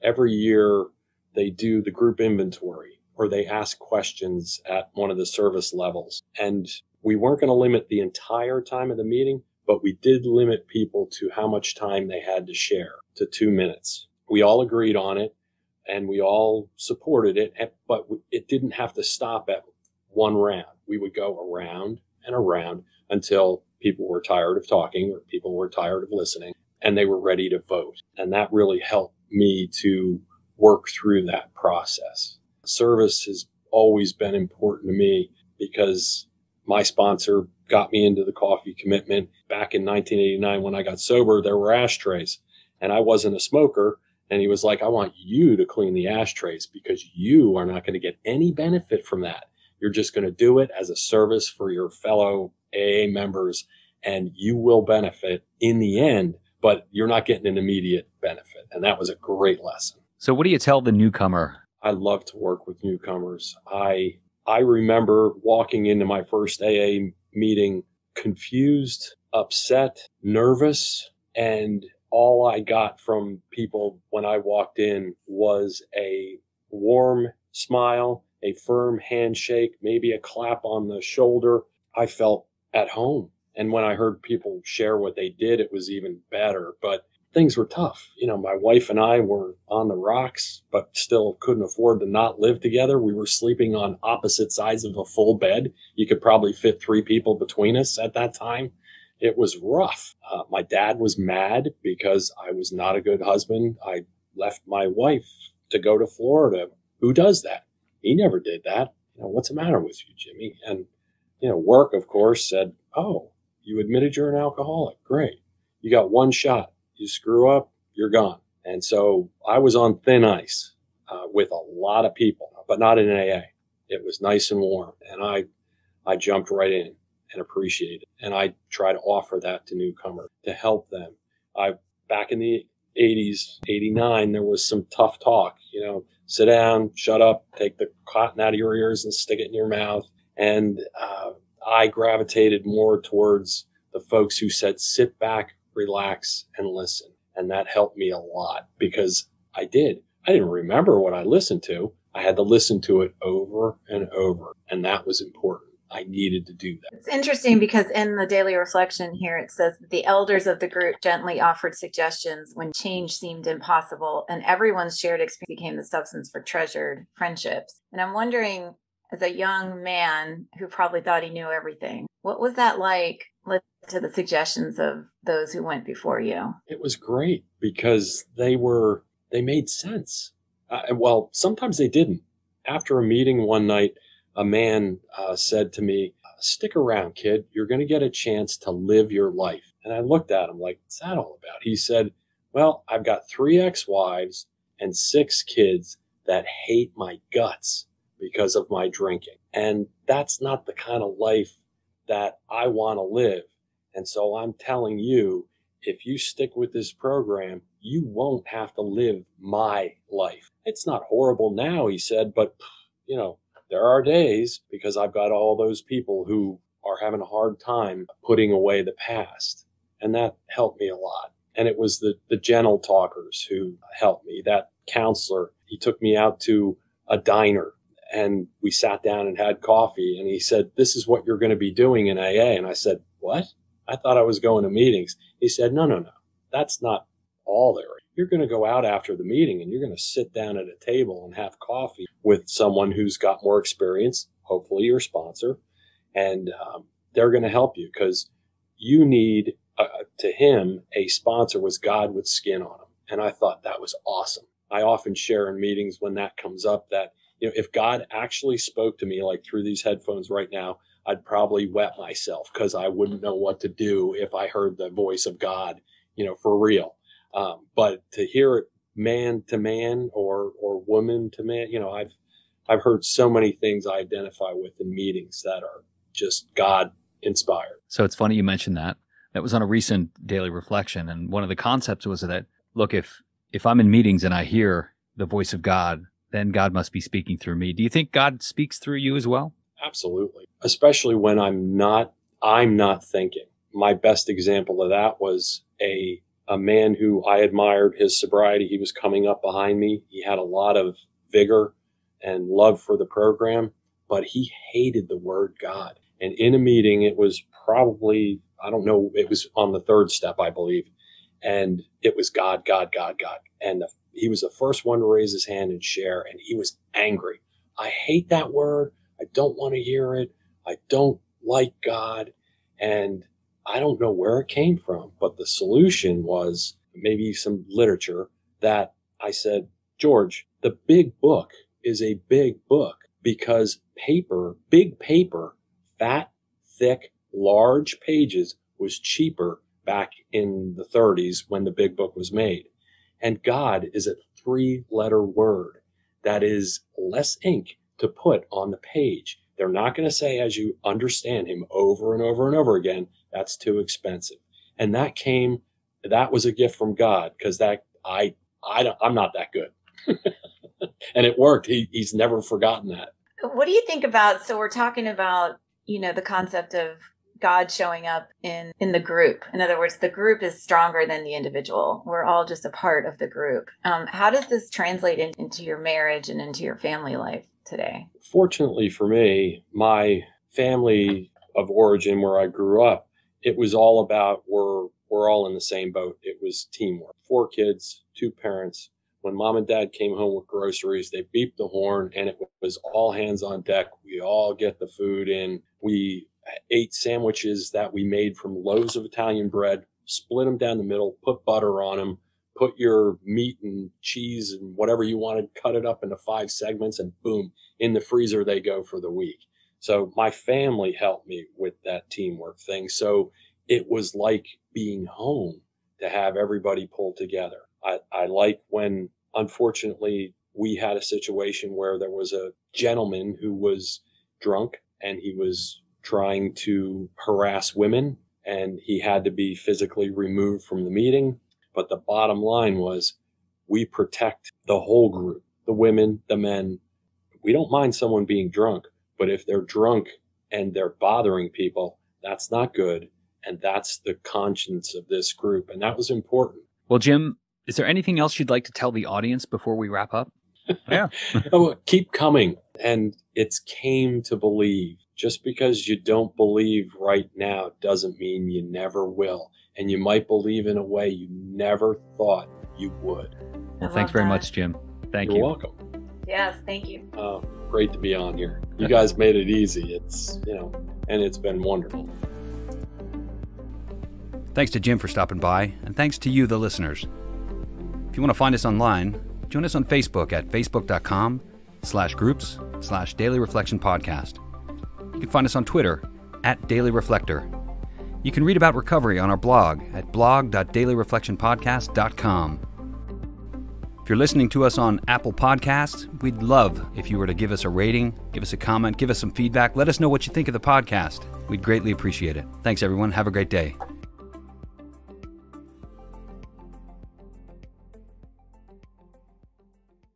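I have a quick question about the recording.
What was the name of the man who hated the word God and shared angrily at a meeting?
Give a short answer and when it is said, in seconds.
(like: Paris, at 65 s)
George, at 329 s.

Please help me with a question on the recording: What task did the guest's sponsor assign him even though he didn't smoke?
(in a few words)
Clean the ashtrays.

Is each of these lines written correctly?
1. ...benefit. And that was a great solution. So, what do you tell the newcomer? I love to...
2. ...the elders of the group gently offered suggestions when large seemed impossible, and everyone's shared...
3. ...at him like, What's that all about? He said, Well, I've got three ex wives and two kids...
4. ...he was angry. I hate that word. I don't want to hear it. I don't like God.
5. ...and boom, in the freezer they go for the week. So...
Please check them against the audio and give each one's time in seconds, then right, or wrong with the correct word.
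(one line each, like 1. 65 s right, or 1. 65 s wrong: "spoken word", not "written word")
1. 58 s wrong: "lesson", not "solution"
2. 159 s wrong: "change", not "large"
3. 190 s wrong: "six", not "two"
4. 316 s right
5. 406 s right.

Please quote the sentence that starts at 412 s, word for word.
So it was like being home to have everybody pull together.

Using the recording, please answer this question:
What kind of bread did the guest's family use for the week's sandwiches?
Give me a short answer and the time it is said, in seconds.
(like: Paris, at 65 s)
Italian bread, at 399 s.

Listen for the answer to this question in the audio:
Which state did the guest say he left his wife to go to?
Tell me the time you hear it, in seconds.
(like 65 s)
106 s.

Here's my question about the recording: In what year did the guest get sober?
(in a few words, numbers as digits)
1989.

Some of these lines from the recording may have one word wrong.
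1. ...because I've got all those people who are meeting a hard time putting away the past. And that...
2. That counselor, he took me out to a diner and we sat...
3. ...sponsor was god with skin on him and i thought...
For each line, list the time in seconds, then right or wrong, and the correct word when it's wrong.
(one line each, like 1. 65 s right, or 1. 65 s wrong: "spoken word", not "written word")
1. 214 s wrong: "having", not "meeting"
2. 224 s right
3. 251 s right.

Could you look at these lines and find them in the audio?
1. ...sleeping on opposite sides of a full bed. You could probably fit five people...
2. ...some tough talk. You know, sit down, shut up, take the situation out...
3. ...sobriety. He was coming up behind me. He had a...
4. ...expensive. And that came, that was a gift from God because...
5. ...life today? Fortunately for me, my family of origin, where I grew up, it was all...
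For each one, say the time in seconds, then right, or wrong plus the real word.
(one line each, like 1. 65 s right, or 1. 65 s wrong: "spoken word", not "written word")
1. 93 s wrong: "three", not "five"
2. 134 s wrong: "cotton", not "situation"
3. 298 s right
4. 353 s right
5. 377 s right.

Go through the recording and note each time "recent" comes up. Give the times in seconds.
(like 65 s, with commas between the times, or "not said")
279 s.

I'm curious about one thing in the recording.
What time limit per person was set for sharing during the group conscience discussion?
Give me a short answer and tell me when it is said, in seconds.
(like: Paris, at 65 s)
2 minutes, at 13 s.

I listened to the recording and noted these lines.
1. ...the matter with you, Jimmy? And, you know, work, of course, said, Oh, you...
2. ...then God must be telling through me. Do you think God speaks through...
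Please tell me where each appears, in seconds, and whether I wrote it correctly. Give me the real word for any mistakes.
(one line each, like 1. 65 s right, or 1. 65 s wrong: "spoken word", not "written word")
1. 109 s right
2. 286 s wrong: "speaking", not "telling".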